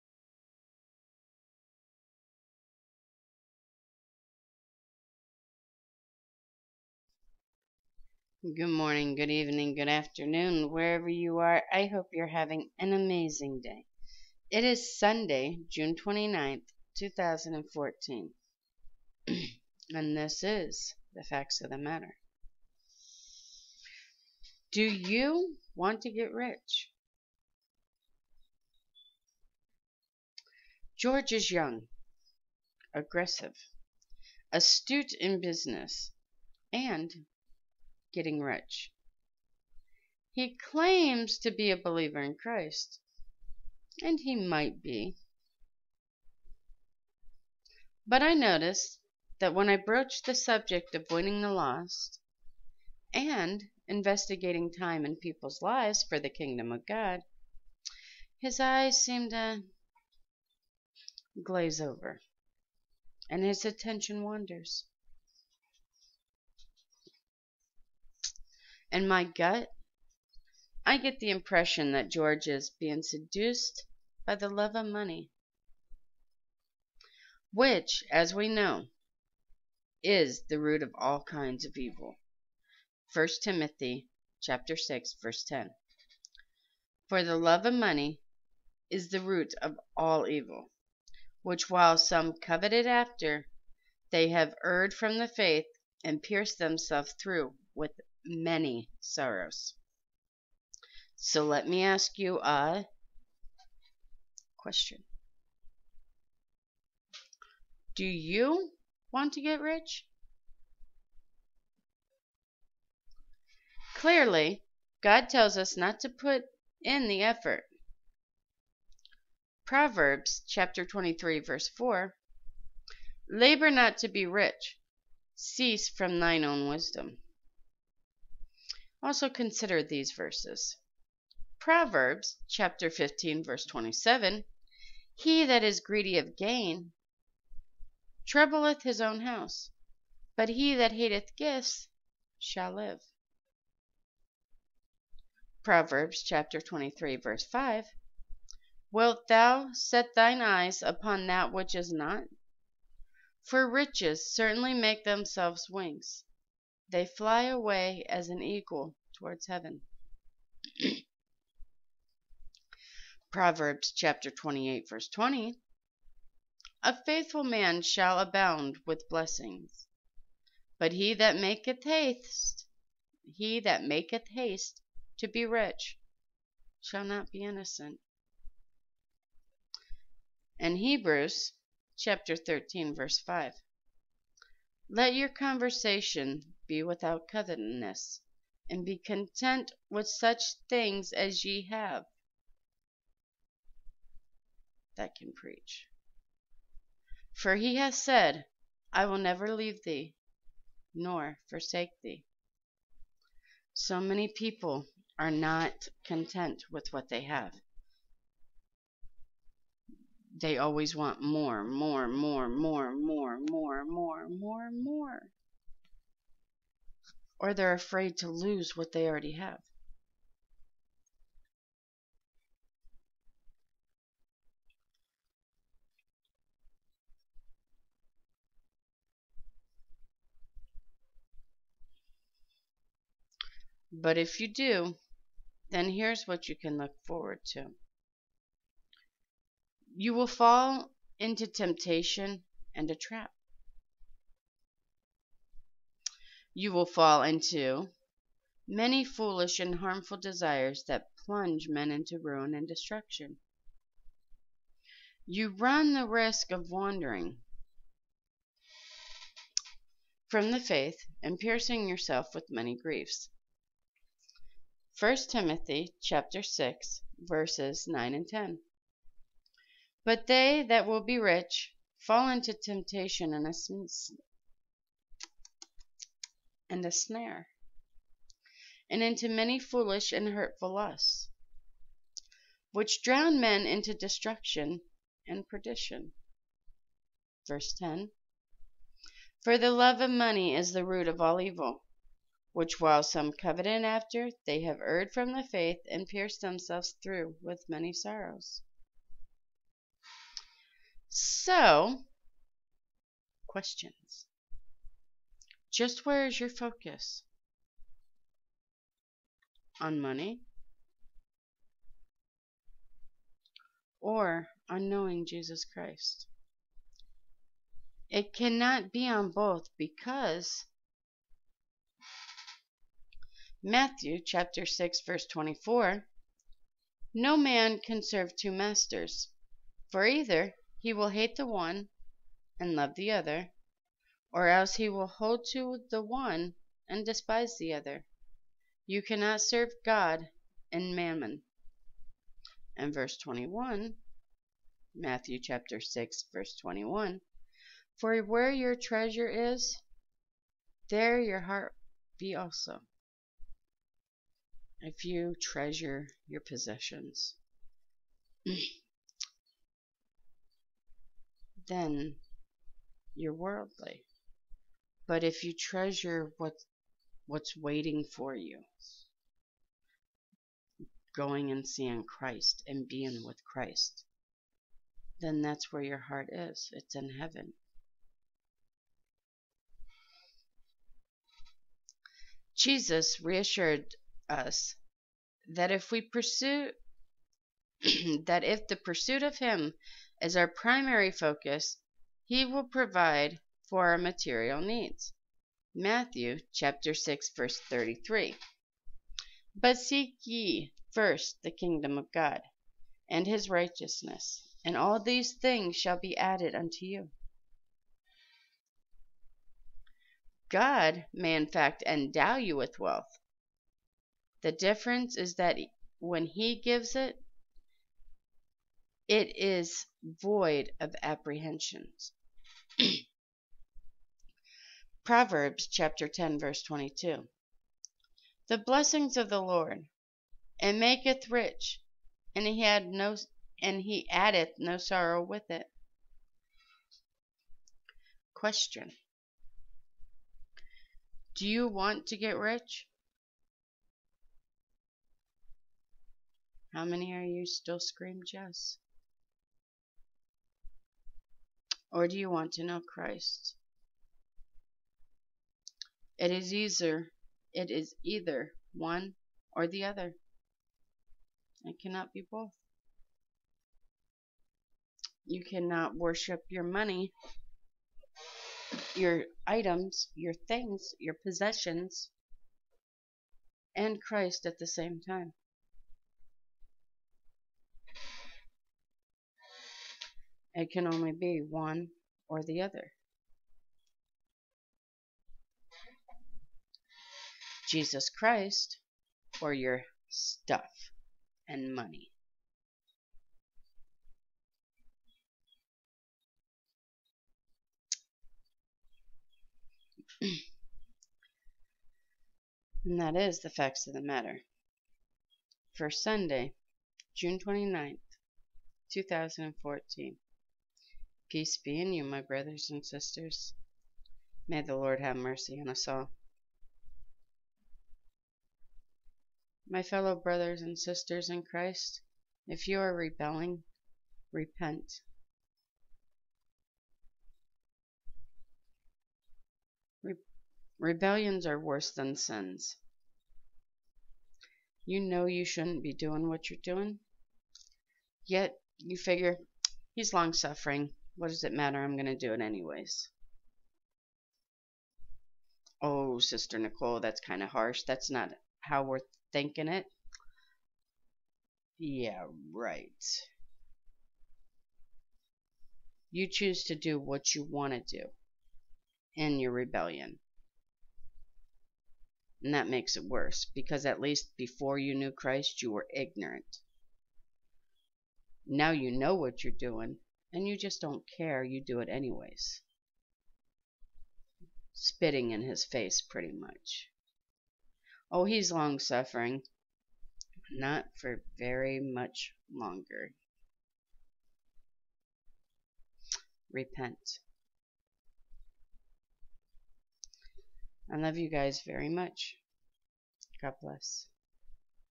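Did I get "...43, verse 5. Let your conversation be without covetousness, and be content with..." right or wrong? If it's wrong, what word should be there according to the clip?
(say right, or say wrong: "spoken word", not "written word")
wrong: "13", not "43".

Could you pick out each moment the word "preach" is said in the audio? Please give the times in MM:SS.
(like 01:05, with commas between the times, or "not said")
03:15.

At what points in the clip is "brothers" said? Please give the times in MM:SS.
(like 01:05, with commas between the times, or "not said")
08:32, 08:40.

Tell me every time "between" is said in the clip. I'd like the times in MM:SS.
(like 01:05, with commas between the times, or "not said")
not said.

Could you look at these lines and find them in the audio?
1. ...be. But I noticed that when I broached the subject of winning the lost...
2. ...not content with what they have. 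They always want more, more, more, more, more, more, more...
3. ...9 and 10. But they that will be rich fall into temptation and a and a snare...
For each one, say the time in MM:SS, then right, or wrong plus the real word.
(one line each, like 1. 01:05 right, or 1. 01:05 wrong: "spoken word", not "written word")
1. 00:44 right
2. 03:25 right
3. 04:27 right.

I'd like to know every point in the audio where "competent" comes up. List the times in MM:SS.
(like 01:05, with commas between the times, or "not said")
not said.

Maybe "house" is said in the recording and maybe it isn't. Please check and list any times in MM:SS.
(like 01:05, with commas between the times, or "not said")
02:19.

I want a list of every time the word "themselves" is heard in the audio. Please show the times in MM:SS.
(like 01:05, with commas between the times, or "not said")
01:36, 02:35, 04:56.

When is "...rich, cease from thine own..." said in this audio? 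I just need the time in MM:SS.
02:04.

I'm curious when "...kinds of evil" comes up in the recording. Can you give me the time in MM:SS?
01:21.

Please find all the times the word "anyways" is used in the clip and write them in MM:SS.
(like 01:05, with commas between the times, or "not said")
09:02, 09:31.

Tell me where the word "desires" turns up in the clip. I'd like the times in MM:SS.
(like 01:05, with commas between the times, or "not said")
04:10.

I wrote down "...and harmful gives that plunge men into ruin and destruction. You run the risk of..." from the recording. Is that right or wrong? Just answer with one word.
wrong.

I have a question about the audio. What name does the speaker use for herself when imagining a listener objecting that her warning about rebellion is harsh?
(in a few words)
Sister Nicole.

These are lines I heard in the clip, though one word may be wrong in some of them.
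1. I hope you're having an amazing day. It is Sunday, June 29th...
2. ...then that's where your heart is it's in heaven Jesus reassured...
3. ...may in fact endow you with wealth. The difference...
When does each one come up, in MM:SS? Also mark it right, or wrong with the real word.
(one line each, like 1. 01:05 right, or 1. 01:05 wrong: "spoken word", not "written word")
1. 00:11 right
2. 06:15 right
3. 06:51 right.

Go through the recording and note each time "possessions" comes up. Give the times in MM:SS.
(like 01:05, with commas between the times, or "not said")
05:56, 07:51.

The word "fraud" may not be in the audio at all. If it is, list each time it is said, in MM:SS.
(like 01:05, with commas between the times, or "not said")
not said.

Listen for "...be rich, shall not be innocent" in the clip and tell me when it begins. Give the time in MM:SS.
02:55.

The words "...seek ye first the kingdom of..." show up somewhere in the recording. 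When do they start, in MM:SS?
06:39.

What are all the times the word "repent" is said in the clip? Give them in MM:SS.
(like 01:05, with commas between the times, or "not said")
08:44, 09:46.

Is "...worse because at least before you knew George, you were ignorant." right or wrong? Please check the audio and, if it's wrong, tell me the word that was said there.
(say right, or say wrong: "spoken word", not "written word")
wrong: "Christ", not "George".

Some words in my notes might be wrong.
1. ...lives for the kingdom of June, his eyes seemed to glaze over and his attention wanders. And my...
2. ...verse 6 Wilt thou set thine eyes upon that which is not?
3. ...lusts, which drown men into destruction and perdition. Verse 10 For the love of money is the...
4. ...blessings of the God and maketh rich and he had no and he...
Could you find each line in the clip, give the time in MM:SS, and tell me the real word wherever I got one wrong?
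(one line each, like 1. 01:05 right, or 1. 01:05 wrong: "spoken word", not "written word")
1. 00:55 wrong: "God", not "June"
2. 02:27 wrong: "5", not "6"
3. 04:40 right
4. 07:08 wrong: "Lord", not "God".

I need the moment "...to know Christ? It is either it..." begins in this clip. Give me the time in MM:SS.
07:32.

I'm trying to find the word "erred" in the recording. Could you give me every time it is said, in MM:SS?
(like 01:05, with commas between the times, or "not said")
01:34, 04:54.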